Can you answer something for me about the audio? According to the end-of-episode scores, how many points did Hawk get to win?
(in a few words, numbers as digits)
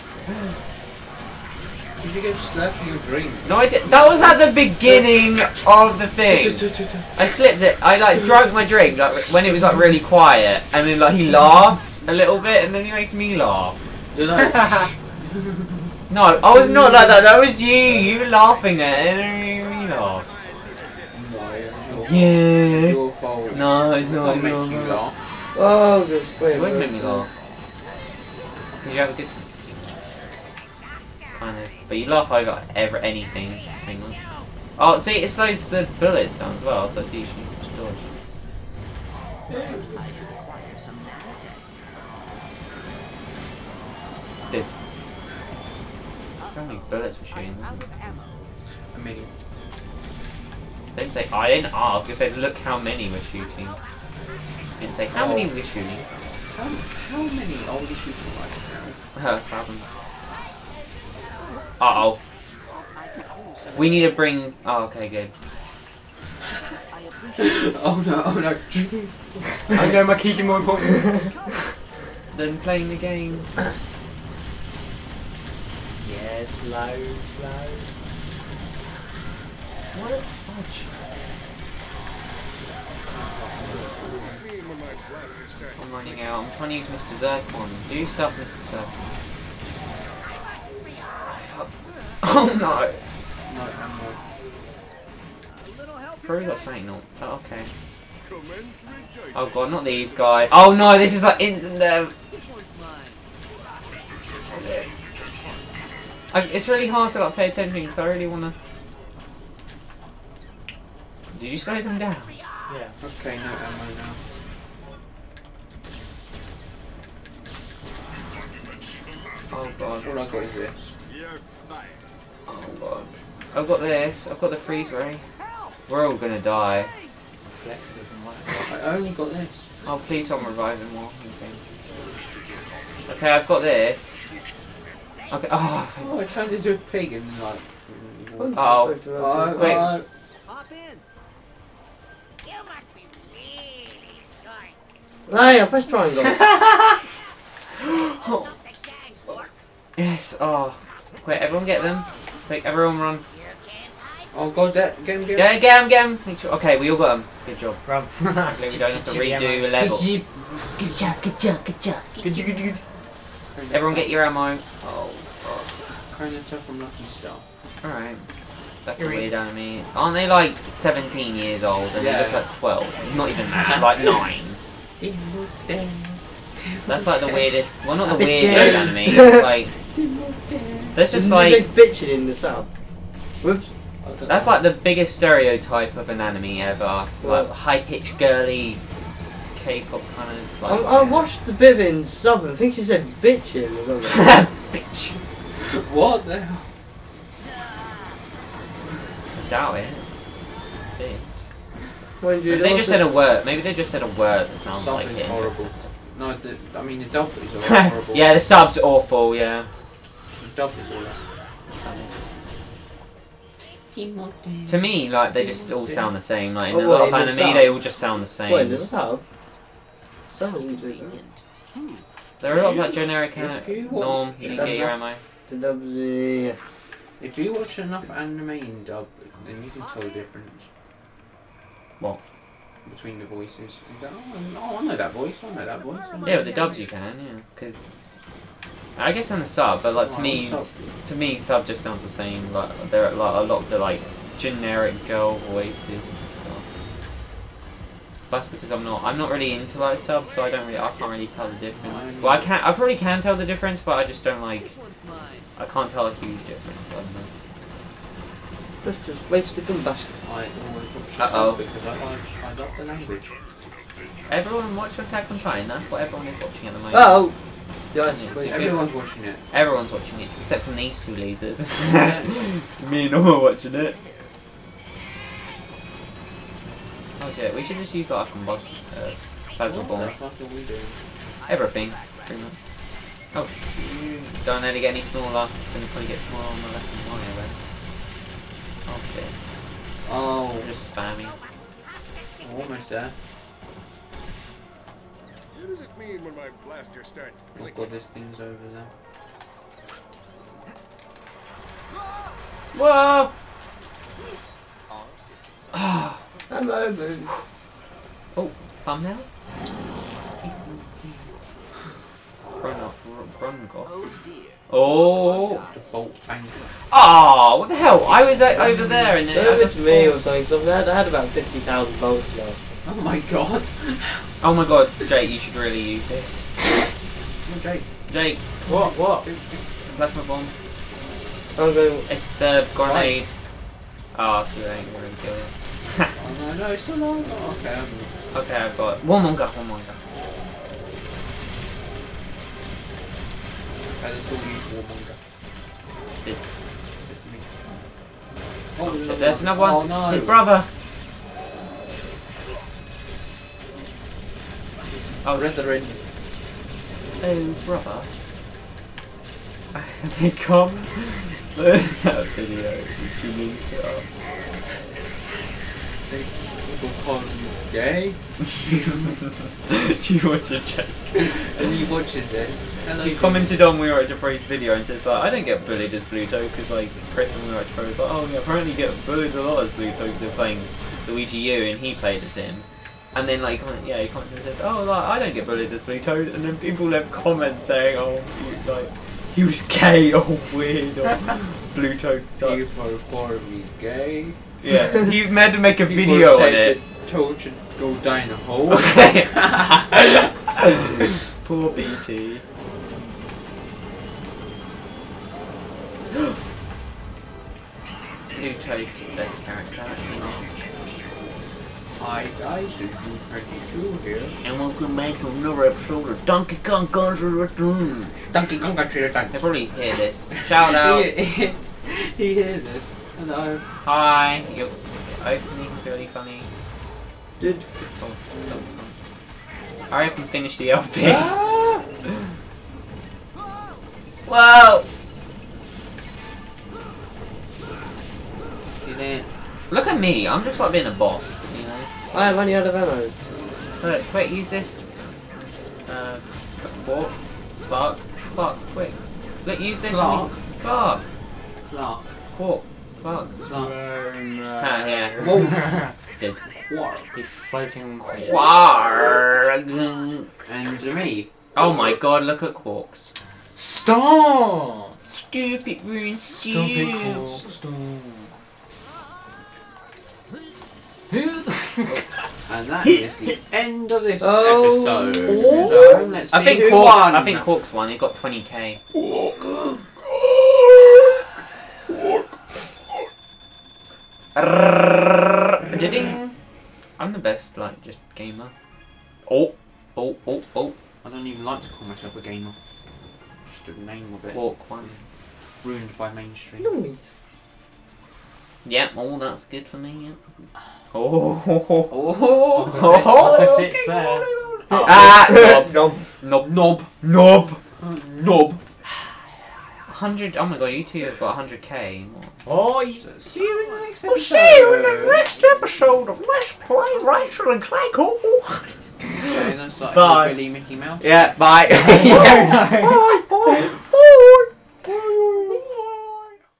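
20k.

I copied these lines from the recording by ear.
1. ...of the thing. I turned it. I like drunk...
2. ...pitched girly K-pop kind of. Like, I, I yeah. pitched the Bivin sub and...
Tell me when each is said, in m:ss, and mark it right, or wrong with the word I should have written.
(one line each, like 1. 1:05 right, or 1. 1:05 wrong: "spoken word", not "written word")
1. 0:05 wrong: "slipped", not "turned"
2. 3:07 wrong: "watched", not "pitched".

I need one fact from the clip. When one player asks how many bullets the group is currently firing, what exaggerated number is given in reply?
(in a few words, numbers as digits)
1000.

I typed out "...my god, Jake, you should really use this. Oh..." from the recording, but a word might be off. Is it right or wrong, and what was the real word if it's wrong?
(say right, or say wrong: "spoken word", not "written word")
right.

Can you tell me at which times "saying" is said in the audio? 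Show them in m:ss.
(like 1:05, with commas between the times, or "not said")
1:36, 6:27.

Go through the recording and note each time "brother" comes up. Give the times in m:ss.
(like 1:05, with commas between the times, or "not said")
5:50, 5:57.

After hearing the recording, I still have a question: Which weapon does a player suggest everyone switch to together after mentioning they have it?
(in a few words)
Warmonger.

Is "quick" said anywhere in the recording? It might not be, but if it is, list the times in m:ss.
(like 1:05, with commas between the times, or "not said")
2:31, 7:24, 7:28.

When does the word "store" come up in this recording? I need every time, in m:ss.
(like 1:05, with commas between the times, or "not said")
not said.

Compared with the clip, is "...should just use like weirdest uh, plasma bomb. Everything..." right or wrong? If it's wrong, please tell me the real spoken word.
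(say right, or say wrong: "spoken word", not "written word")
wrong: "combust", not "weirdest".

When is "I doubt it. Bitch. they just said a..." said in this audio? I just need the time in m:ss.
3:19.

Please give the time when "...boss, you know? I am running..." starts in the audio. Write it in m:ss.
7:20.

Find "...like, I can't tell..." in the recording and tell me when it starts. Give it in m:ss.
4:14.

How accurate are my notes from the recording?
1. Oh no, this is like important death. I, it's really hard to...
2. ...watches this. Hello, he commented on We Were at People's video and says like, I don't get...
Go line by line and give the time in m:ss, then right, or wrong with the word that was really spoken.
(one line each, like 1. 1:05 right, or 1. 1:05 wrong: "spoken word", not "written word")
1. 1:40 wrong: "instant", not "important"
2. 6:11 wrong: "Jabri", not "People".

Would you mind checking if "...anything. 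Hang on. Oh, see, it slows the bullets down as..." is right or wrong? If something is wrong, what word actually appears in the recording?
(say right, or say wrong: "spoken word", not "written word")
right.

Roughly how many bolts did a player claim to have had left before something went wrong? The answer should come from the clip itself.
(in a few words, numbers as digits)
50000.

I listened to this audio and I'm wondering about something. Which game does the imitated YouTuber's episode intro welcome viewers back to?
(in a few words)
Donkey Kong Country Returns.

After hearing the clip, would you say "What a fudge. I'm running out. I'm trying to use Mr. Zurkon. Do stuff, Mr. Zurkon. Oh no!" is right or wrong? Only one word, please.
right.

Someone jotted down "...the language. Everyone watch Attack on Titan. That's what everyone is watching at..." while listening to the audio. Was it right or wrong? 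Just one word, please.
right.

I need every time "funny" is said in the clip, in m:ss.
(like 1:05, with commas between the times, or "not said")
7:06.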